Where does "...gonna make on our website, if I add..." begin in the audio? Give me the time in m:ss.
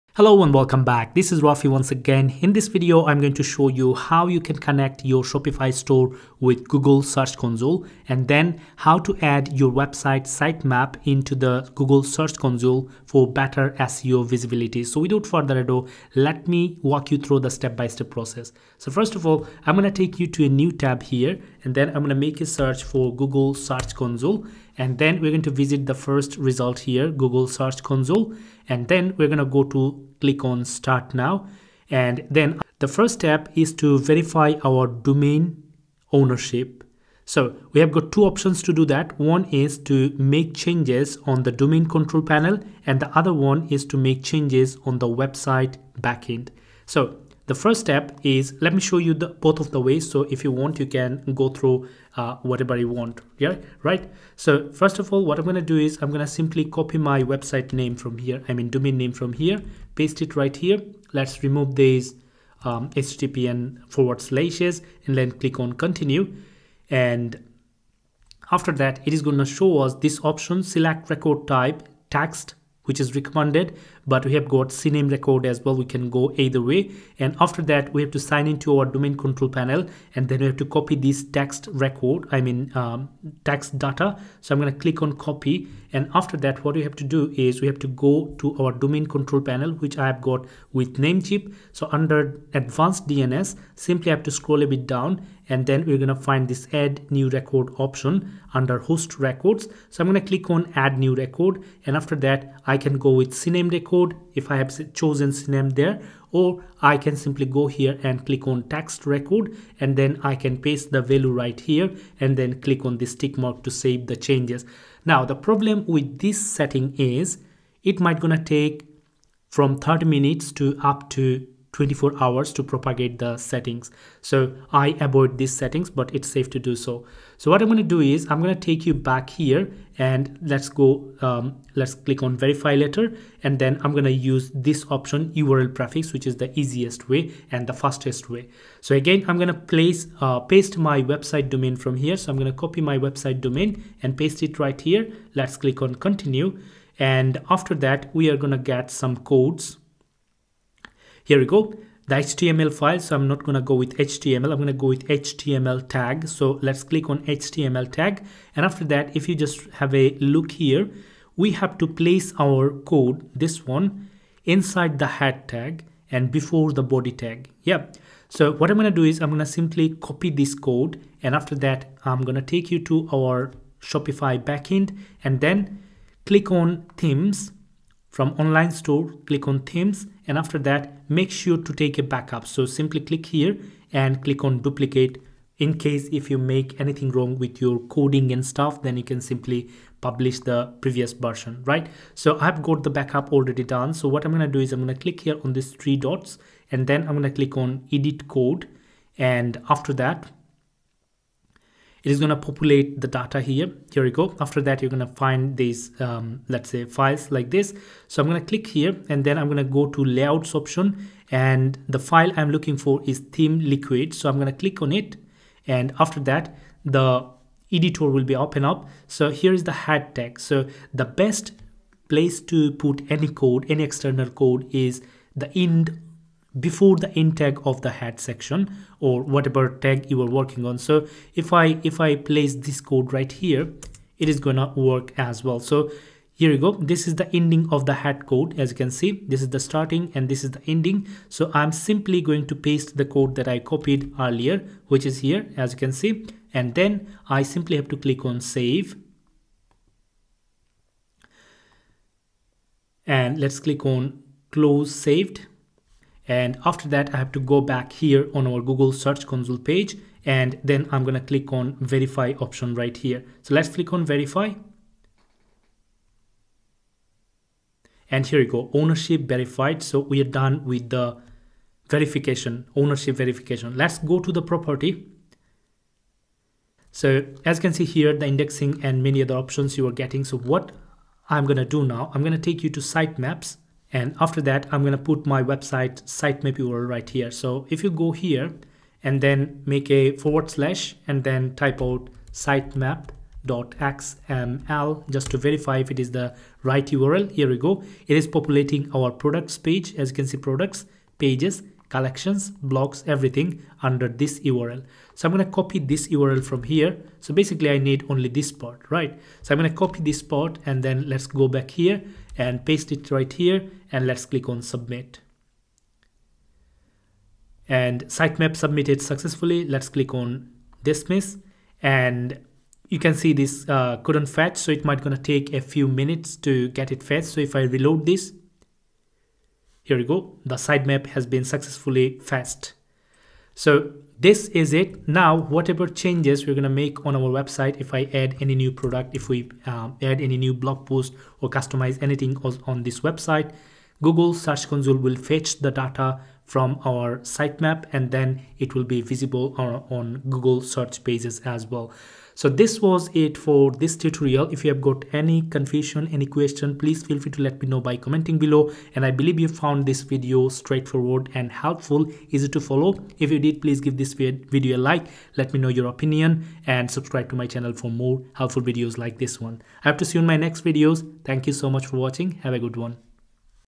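5:36.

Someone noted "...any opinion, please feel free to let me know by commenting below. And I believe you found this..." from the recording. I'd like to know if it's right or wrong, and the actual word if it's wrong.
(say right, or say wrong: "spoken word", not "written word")
wrong: "question", not "opinion".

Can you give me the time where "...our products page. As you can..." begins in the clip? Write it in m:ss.
4:58.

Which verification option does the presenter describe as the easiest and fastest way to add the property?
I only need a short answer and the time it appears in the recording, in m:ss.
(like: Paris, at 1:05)
URL prefix, at 2:15.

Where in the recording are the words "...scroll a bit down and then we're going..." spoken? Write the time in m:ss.
1:34.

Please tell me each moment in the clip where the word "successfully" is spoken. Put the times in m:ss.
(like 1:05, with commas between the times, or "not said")
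5:19, 5:31.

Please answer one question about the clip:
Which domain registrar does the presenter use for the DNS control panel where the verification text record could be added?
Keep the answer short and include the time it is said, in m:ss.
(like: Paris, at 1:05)
Namecheap, at 1:30.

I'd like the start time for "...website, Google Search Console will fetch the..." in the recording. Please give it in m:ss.
5:43.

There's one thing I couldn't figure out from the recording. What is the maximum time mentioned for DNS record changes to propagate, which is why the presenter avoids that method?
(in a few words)
24 hours.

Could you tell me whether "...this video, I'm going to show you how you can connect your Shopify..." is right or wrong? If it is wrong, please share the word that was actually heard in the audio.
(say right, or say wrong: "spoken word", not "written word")
right.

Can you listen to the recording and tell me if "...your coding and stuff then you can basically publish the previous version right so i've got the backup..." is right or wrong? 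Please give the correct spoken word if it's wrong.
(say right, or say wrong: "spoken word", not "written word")
wrong: "simply", not "basically".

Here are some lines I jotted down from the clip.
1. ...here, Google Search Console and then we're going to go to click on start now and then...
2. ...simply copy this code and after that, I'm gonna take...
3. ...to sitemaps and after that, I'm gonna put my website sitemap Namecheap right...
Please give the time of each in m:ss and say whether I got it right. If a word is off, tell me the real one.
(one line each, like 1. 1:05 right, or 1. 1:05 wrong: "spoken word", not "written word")
1. 0:26 right
2. 2:49 right
3. 4:42 wrong: "URL", not "Namecheap".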